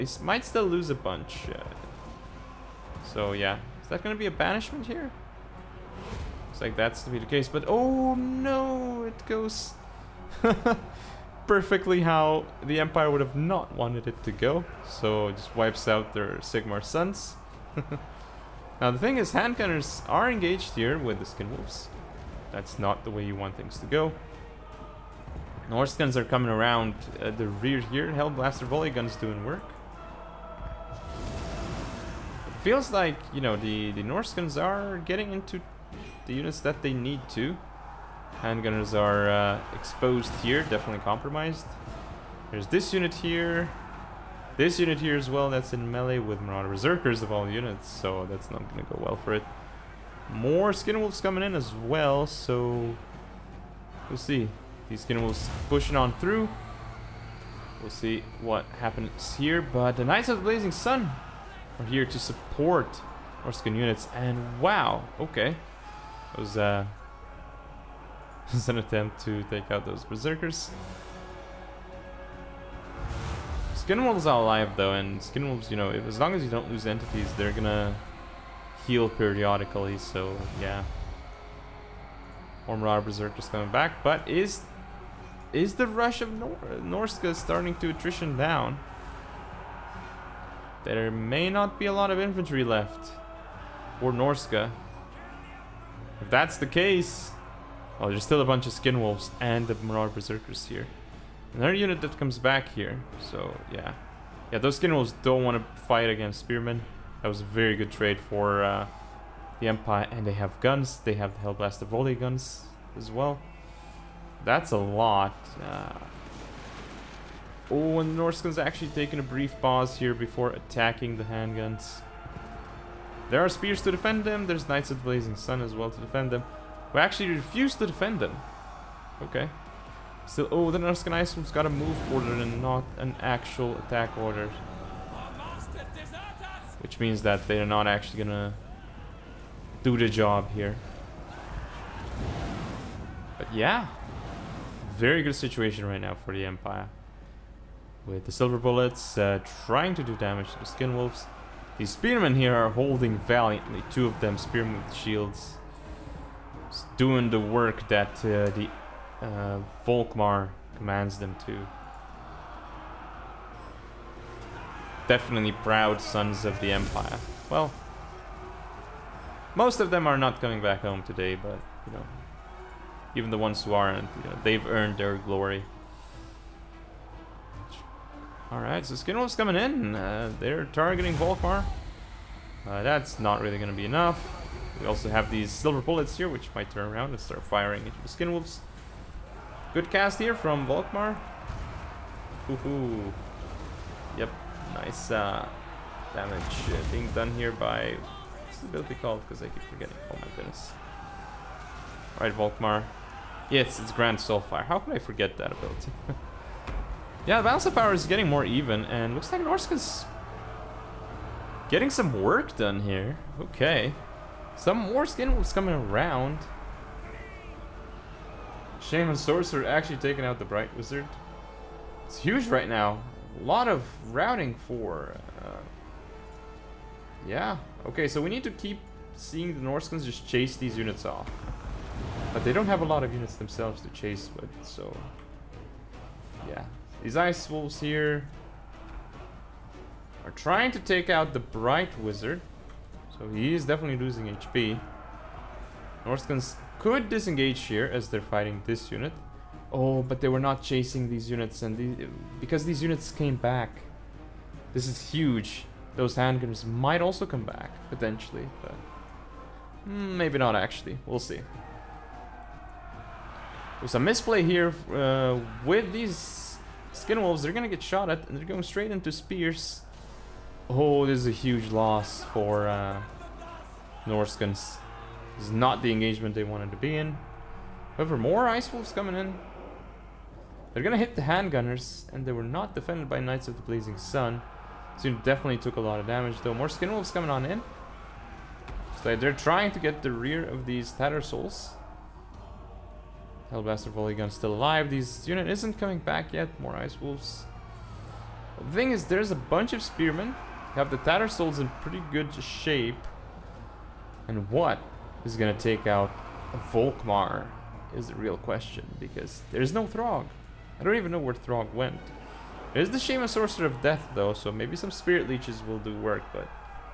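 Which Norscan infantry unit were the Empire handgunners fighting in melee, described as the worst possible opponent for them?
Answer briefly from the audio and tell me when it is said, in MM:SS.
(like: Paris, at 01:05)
Marauder Berserkers, at 00:46.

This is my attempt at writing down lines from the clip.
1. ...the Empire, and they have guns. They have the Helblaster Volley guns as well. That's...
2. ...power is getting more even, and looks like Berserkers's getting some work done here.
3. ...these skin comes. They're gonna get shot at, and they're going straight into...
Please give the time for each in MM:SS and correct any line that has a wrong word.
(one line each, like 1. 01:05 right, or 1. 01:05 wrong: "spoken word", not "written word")
1. 01:49 right
2. 03:27 wrong: "Norsca", not "Berserkers"
3. 04:25 wrong: "wolves", not "comes".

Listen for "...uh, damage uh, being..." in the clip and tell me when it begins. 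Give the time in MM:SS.
03:15.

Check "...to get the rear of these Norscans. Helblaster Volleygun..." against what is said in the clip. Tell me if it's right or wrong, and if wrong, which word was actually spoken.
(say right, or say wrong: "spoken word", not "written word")
wrong: "Tattersouls", not "Norscans".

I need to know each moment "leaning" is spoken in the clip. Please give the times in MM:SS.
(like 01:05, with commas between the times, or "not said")
not said.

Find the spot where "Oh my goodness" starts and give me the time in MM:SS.
03:20.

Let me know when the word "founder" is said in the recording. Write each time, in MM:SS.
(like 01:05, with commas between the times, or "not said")
not said.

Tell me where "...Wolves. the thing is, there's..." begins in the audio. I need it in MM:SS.
04:57.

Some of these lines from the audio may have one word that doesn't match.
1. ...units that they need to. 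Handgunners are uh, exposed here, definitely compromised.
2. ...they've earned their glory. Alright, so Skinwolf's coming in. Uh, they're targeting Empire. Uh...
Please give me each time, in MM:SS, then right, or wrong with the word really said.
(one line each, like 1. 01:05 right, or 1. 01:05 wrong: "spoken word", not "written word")
1. 00:36 right
2. 02:54 wrong: "Volkmar", not "Empire".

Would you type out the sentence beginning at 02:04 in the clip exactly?
There's Knights of the Blazing Sun as well to defend them.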